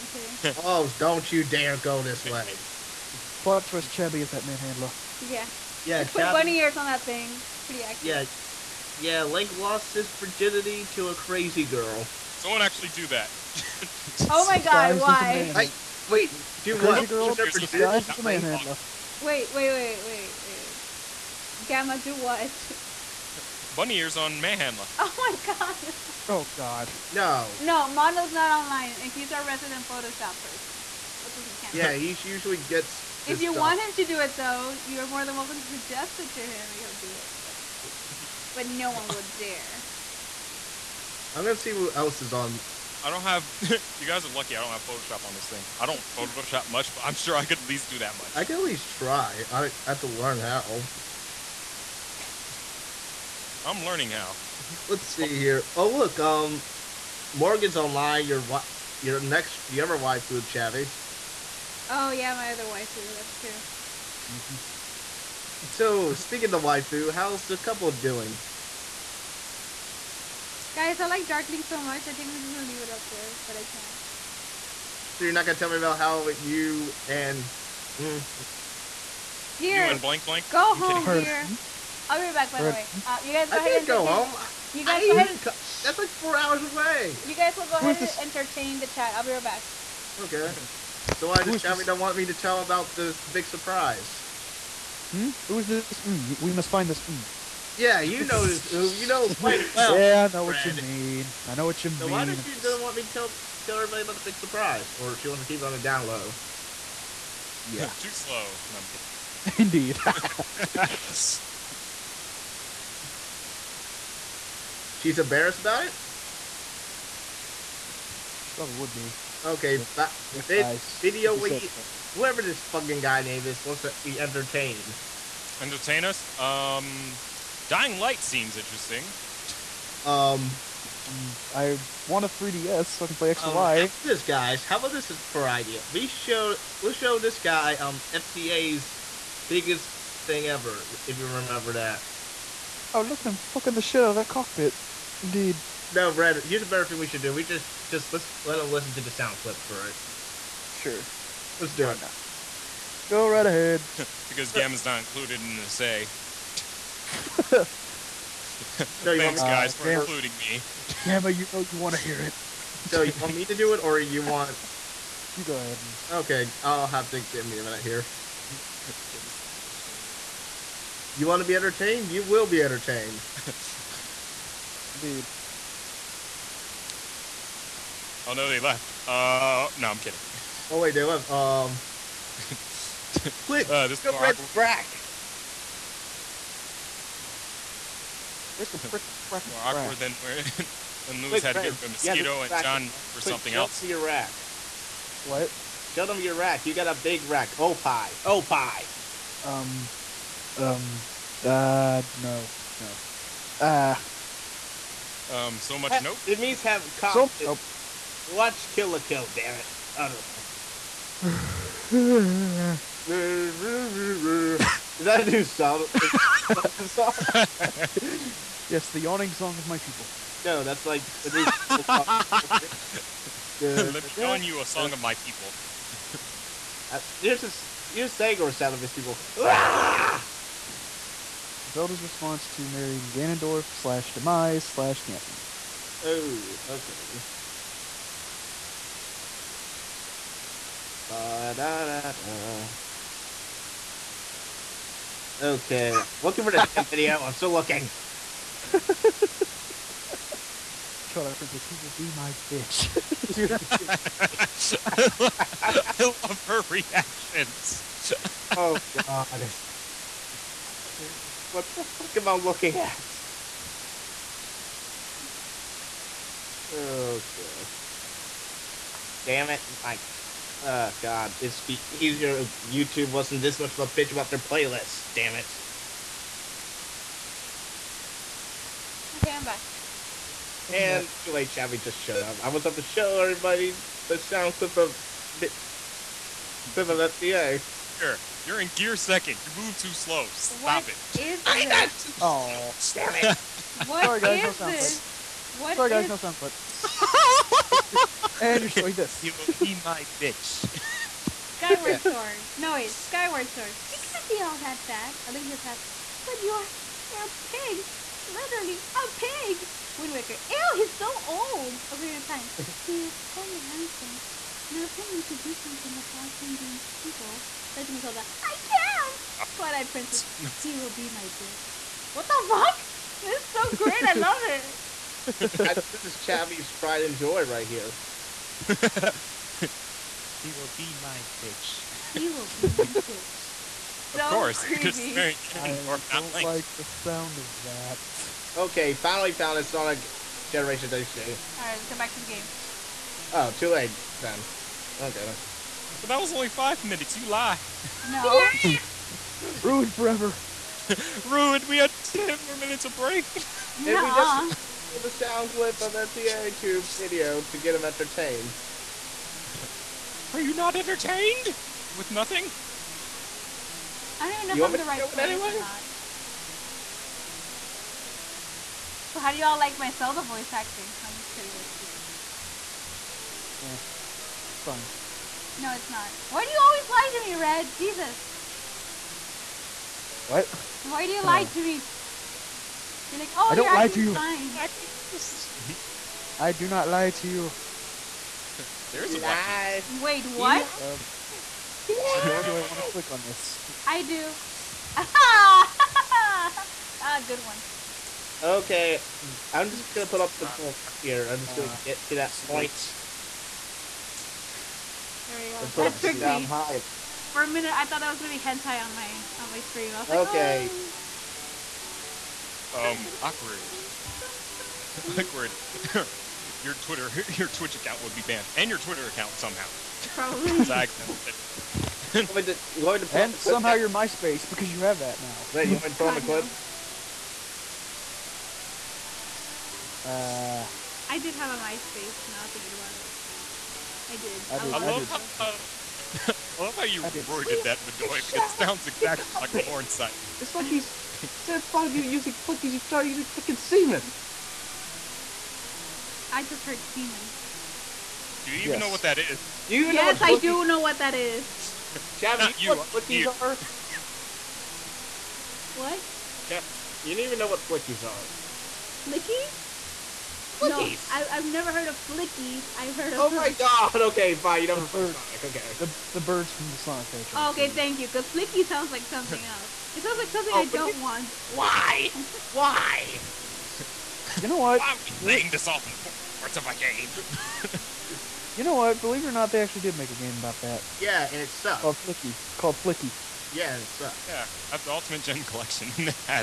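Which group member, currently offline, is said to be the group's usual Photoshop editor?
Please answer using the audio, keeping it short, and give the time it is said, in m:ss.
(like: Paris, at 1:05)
Mondo, at 0:27.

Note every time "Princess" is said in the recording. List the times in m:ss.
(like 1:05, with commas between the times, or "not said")
4:11, 5:19.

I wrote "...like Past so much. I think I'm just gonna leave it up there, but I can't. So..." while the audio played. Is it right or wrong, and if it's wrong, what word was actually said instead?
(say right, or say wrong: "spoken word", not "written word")
wrong: "Darkling", not "Past".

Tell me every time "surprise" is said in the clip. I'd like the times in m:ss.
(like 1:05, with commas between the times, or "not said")
1:33, 1:44.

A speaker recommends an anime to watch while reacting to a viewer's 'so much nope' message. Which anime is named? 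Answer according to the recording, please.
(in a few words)
Kill la Kill.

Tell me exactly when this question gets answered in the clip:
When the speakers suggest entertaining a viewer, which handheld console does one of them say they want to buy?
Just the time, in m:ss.
2:12.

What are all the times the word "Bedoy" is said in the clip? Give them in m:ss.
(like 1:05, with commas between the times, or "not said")
7:17.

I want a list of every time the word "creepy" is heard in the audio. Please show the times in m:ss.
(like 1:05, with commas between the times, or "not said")
5:34.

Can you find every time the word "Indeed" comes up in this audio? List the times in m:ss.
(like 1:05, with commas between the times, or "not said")
1:49, 2:25.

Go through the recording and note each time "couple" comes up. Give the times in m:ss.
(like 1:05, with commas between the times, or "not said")
1:07.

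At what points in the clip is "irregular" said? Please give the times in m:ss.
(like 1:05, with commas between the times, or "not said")
not said.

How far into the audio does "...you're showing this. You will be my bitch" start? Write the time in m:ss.
4:58.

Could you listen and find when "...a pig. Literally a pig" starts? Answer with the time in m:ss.
5:07.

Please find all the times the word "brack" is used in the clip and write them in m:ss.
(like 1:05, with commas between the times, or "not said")
3:04.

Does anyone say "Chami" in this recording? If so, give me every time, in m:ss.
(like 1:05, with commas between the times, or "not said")
1:31.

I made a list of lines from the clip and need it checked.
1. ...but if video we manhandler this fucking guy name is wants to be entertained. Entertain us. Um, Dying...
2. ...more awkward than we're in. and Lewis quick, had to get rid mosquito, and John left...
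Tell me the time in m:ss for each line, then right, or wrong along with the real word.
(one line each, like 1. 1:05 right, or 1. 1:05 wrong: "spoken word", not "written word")
1. 1:59 wrong: "whoever", not "manhandler"
2. 3:09 right.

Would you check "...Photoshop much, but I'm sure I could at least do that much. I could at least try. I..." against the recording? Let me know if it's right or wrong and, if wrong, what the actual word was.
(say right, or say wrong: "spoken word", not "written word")
right.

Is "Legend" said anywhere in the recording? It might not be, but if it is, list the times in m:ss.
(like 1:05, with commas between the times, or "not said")
5:17.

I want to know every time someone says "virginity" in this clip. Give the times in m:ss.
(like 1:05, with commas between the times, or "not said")
0:10.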